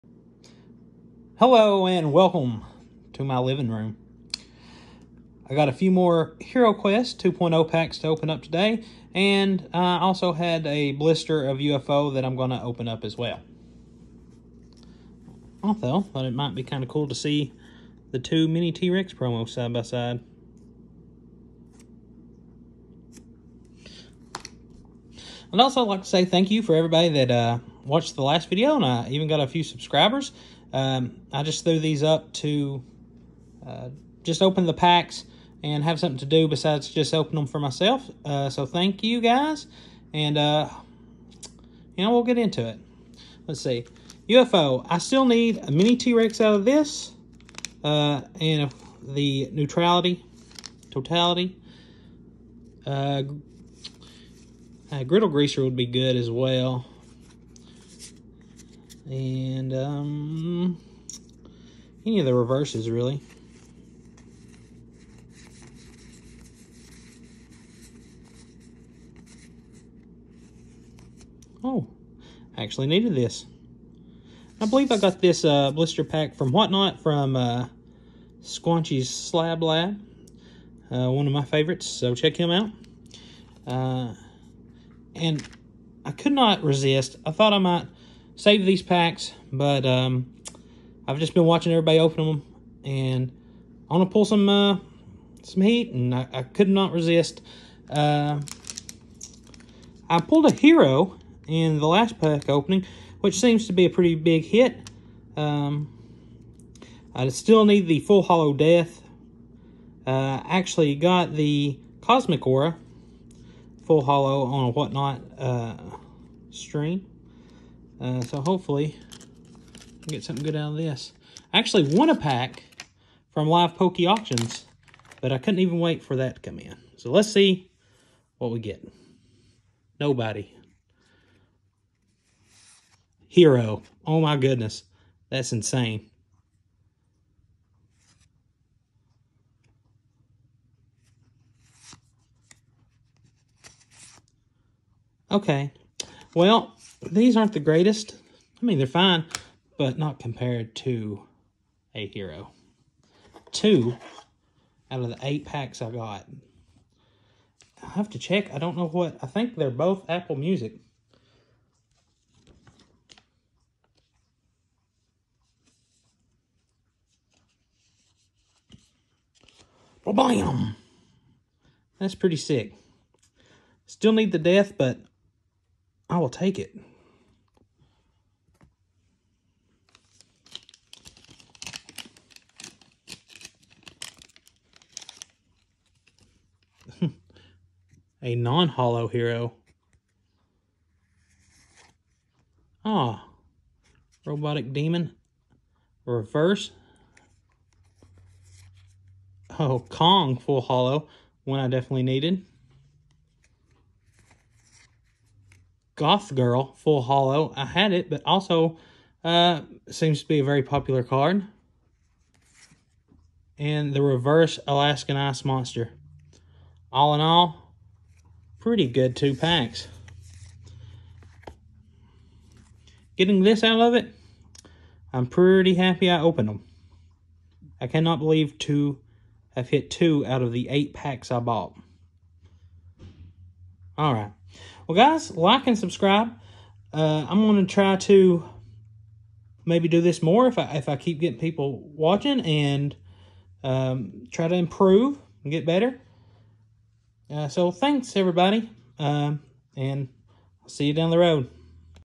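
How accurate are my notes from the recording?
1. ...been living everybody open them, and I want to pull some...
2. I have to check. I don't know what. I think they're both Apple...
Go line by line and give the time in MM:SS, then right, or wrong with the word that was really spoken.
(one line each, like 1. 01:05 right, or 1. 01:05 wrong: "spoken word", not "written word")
1. 01:31 wrong: "watching", not "living"
2. 02:37 right.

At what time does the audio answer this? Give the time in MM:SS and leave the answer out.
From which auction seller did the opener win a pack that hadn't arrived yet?
02:03.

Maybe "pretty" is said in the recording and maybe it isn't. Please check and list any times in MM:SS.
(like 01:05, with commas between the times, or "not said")
01:43, 02:52, 03:38, 03:45.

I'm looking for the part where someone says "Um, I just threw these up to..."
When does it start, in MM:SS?
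00:30.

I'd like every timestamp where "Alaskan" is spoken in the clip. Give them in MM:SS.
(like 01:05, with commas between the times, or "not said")
03:34.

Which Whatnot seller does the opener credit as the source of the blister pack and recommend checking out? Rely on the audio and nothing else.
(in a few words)
Squanchy's Slab Lab.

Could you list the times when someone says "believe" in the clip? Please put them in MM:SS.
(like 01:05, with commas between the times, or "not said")
01:14, 03:48.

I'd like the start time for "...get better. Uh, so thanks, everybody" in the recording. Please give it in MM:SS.
04:05.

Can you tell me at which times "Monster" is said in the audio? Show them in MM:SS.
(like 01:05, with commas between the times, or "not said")
03:35.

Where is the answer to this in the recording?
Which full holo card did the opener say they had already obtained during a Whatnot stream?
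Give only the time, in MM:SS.
01:52.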